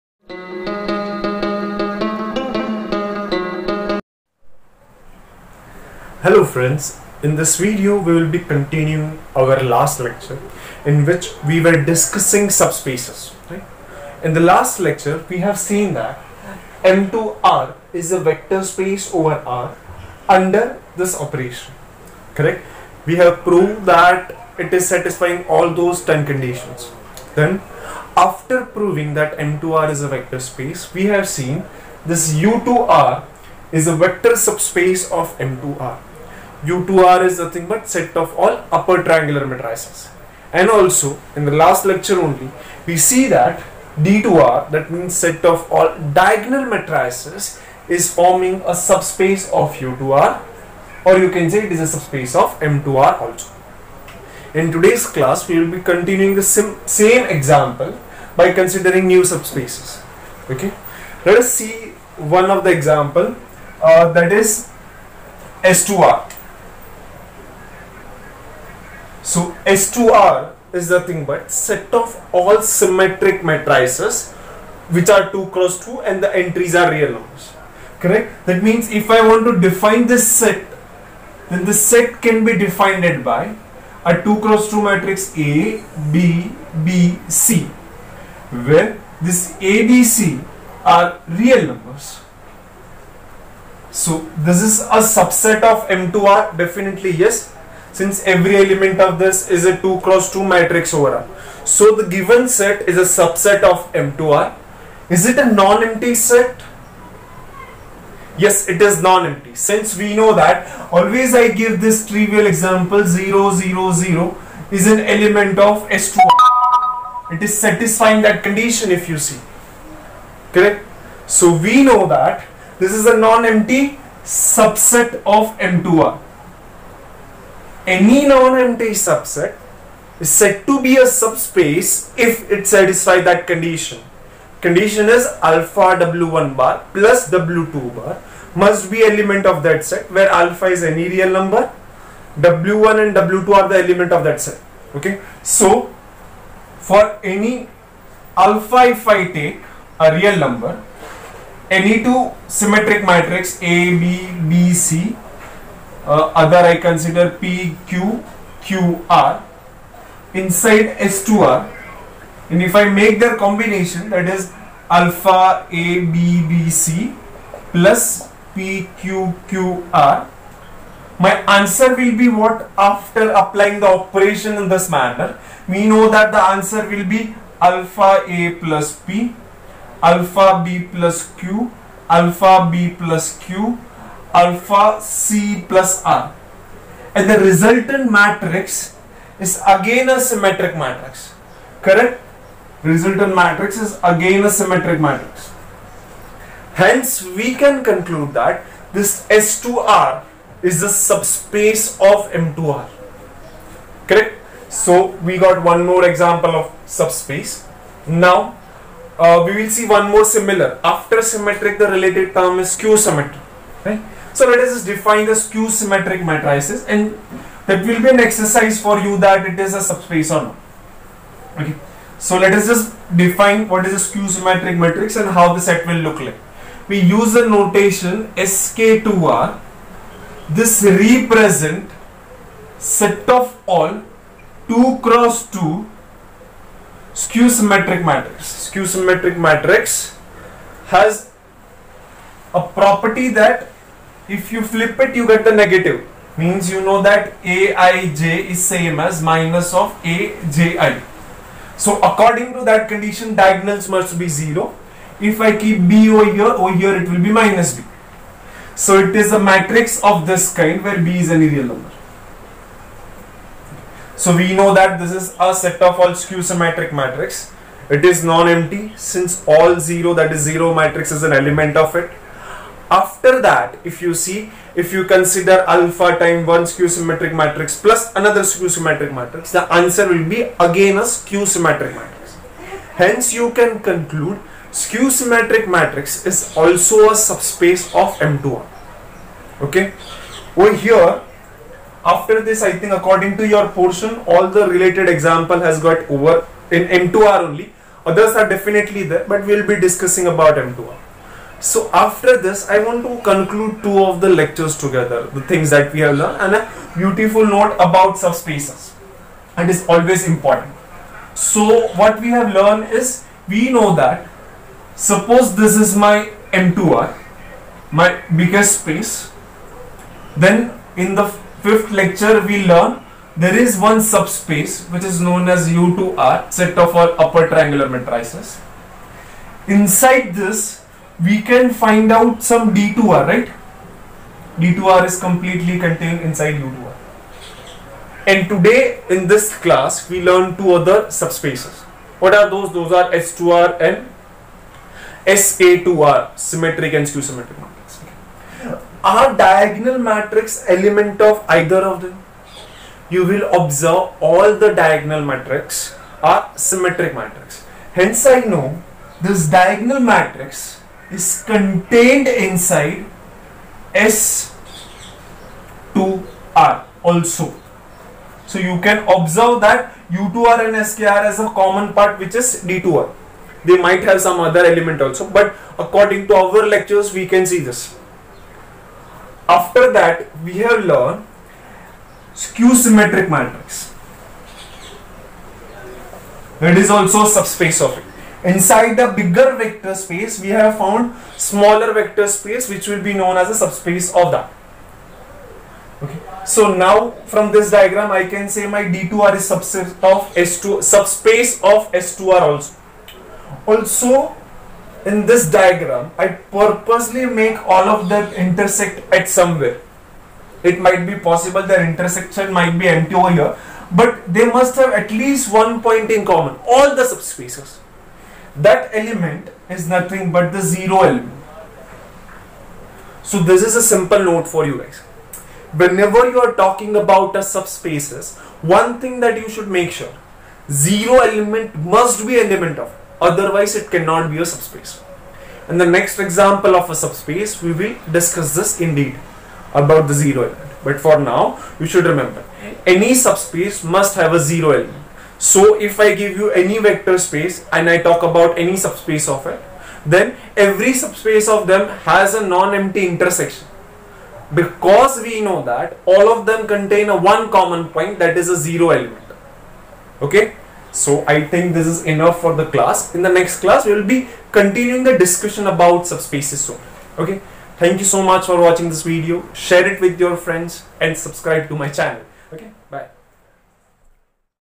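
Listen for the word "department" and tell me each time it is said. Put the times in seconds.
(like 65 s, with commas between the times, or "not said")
not said.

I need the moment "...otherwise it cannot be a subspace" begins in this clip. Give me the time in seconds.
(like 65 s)
433 s.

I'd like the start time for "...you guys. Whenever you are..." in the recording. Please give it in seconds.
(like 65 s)
424 s.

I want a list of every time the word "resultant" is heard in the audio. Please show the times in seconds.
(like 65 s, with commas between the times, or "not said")
187 s, 192 s.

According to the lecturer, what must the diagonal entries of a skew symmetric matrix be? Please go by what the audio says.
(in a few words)
0.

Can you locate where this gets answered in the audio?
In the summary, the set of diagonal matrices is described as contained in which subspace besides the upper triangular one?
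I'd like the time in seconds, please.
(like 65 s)
359 s.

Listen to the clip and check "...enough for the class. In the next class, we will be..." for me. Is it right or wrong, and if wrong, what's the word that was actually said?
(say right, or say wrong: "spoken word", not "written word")
right.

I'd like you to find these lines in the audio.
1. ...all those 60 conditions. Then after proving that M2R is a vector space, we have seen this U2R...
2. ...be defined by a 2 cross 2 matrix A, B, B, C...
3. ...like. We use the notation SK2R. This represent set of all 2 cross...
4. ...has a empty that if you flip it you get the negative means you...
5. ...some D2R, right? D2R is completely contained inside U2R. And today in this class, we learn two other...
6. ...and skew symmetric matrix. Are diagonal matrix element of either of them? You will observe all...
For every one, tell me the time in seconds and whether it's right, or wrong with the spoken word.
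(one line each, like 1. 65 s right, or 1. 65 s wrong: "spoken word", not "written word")
1. 25 s wrong: "10", not "60"
2. 82 s right
3. 226 s right
4. 240 s wrong: "property", not "empty"
5. 332 s right
6. 346 s right.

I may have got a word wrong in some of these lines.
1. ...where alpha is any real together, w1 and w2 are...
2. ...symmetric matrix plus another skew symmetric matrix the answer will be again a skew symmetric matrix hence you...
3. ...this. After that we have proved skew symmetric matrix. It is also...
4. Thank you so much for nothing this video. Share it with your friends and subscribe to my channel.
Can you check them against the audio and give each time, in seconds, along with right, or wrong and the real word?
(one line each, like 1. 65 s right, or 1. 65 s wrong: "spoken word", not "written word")
1. 140 s wrong: "number", not "together"
2. 276 s right
3. 377 s wrong: "learned", not "proved"
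4. 467 s wrong: "watching", not "nothing".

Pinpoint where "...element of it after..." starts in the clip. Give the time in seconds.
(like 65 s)
271 s.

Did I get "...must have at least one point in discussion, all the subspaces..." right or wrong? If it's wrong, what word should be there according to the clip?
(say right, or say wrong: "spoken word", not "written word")
wrong: "common", not "discussion".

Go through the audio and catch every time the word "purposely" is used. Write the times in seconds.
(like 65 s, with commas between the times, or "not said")
406 s.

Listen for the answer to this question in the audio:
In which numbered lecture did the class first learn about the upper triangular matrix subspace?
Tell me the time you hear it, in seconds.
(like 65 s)
321 s.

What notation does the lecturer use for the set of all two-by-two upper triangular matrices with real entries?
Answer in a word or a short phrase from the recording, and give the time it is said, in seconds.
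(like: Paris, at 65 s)
U2R, at 36 s.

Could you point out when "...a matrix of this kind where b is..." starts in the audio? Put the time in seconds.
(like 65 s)
259 s.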